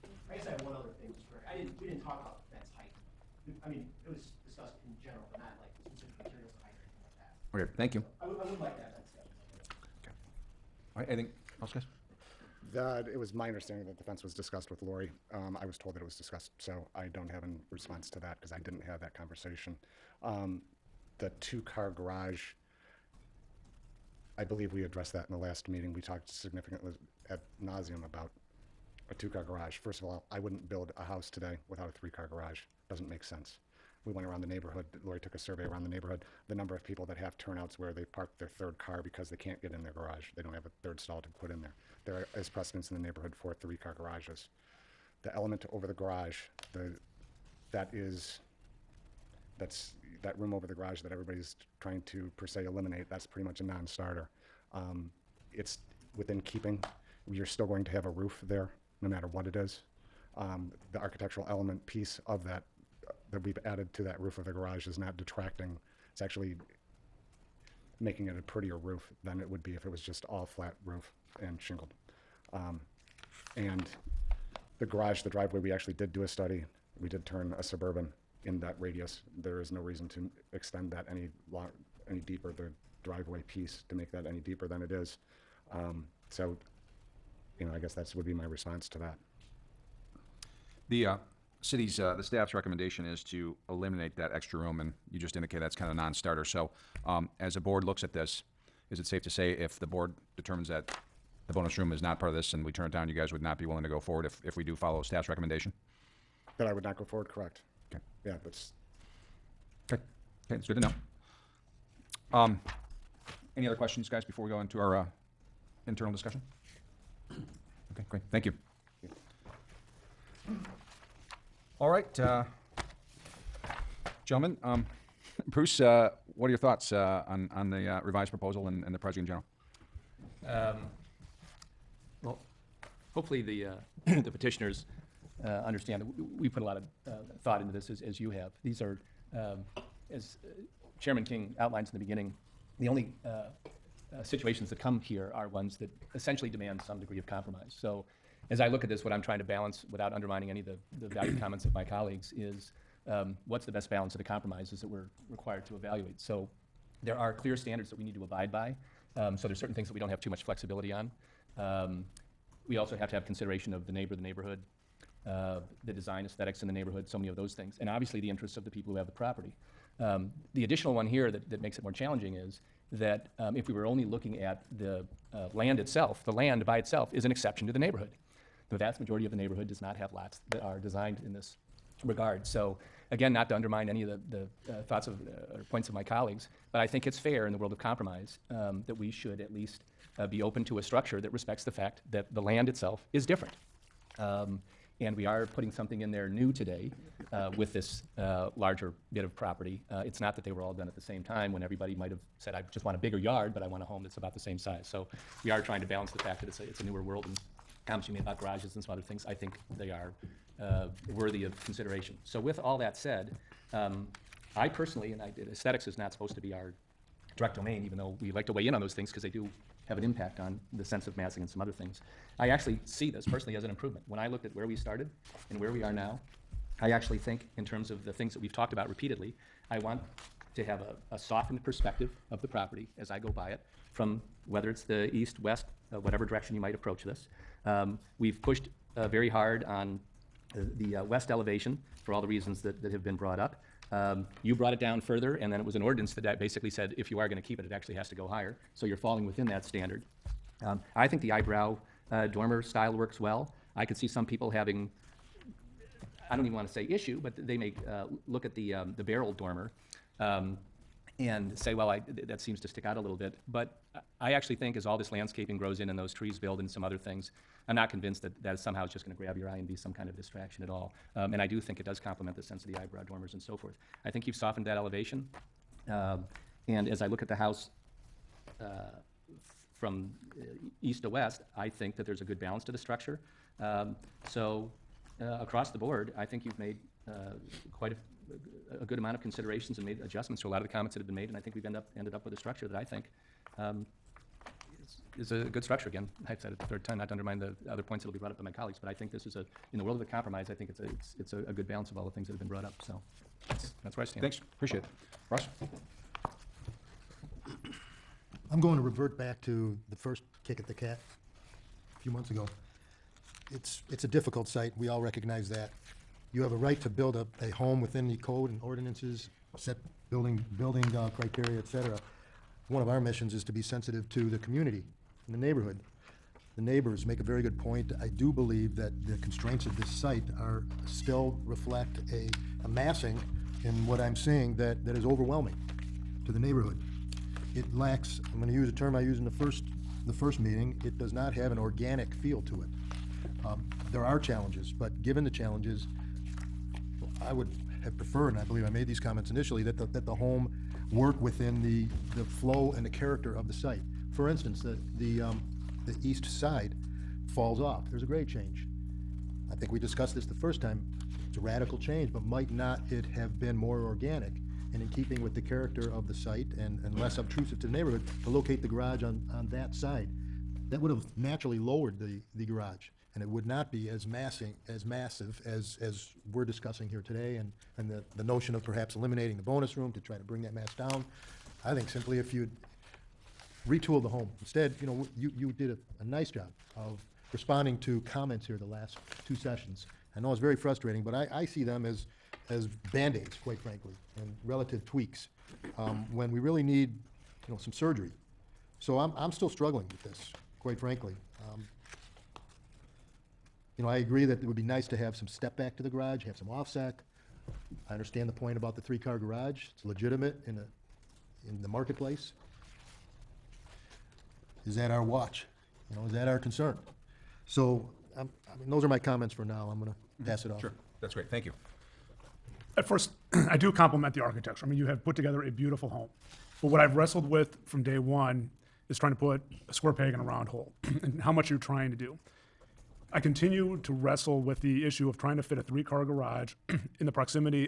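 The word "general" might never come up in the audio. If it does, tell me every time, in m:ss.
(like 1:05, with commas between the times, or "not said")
0:05, 2:09.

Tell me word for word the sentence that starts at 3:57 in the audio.
Um, we've pushed uh, very hard on uh, the uh, west elevation for all the reasons that, that have been brought up.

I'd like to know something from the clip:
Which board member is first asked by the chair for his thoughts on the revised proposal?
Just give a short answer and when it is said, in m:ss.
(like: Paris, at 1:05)
Bruce, at 2:05.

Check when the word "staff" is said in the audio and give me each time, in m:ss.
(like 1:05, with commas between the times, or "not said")
1:32, 1:45.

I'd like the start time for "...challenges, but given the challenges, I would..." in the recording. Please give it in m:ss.
5:44.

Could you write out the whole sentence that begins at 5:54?
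For instance, the, the, um, the east side falls off.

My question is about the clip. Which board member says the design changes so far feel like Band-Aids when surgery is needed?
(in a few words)
Ross.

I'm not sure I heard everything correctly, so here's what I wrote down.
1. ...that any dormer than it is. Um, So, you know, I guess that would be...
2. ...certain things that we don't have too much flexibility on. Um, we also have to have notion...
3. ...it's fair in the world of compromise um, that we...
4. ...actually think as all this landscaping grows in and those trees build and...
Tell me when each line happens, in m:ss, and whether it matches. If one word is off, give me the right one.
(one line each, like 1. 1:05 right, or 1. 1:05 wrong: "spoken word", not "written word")
1. 1:24 wrong: "deeper", not "dormer"
2. 2:39 wrong: "consideration", not "notion"
3. 3:07 right
4. 4:24 right.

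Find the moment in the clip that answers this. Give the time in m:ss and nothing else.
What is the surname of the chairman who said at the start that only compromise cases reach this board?
2:20.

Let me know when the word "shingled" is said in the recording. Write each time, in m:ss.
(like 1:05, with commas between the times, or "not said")
1:11.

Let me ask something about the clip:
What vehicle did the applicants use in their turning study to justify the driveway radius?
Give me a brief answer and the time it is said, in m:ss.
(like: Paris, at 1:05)
Suburban, at 1:17.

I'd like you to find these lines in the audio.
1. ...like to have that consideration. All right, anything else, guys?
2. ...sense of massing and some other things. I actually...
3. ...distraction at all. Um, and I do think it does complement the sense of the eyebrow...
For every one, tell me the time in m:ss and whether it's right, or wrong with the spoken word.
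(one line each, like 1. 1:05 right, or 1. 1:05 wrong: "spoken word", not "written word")
1. 0:08 wrong: "discussion", not "consideration"
2. 3:40 right
3. 4:30 right.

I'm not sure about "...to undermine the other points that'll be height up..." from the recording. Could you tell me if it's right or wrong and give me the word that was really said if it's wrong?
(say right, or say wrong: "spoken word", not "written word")
wrong: "brought", not "height".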